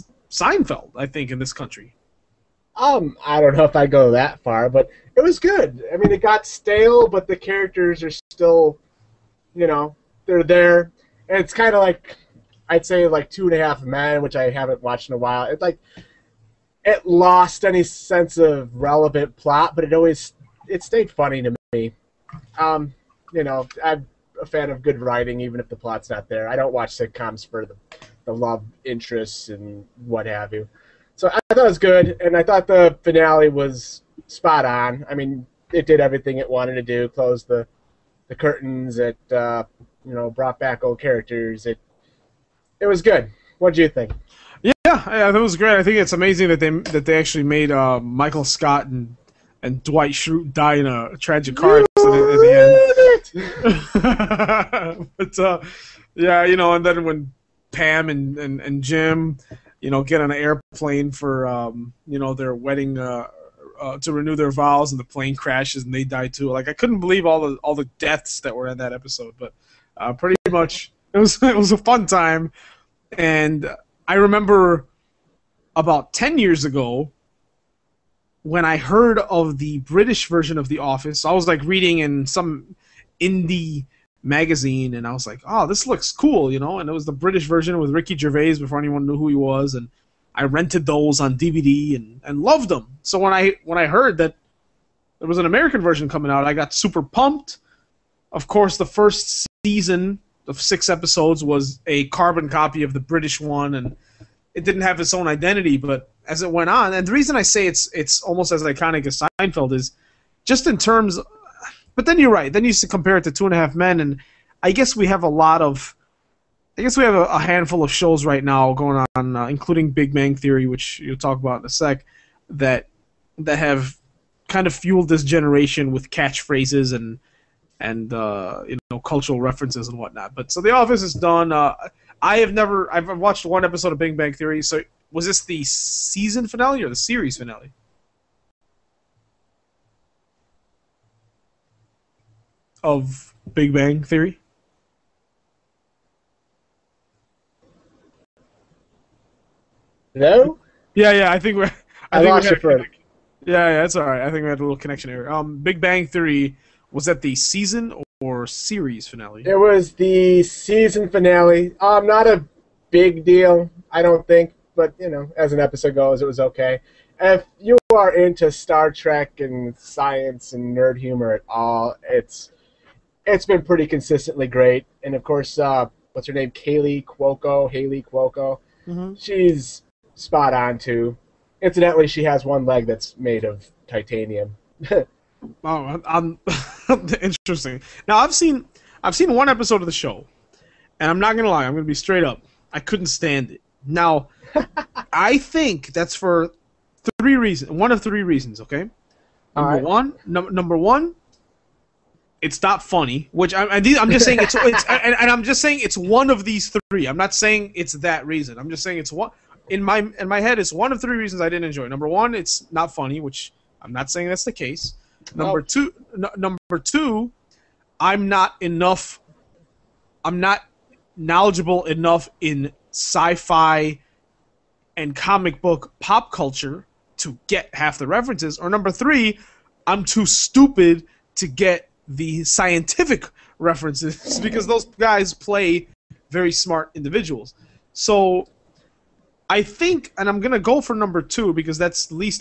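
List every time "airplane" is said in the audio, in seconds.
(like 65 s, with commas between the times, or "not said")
60 s.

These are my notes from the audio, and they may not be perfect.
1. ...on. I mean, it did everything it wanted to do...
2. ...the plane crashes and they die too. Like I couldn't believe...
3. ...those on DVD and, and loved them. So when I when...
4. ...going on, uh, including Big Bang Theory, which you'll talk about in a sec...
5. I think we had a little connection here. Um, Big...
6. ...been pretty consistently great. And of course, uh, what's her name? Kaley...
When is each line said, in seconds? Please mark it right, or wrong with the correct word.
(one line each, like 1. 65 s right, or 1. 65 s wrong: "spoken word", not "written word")
1. 34 s right
2. 64 s right
3. 90 s right
4. 118 s right
5. 154 s right
6. 173 s right.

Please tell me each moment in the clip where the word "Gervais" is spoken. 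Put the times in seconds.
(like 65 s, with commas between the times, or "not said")
88 s.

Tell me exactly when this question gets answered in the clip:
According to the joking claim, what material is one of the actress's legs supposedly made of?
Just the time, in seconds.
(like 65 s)
183 s.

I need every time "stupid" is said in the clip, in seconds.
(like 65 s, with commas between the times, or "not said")
230 s.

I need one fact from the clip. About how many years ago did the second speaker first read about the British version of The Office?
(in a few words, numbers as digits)
10.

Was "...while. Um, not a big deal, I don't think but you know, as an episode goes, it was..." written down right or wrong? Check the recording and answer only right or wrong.
wrong.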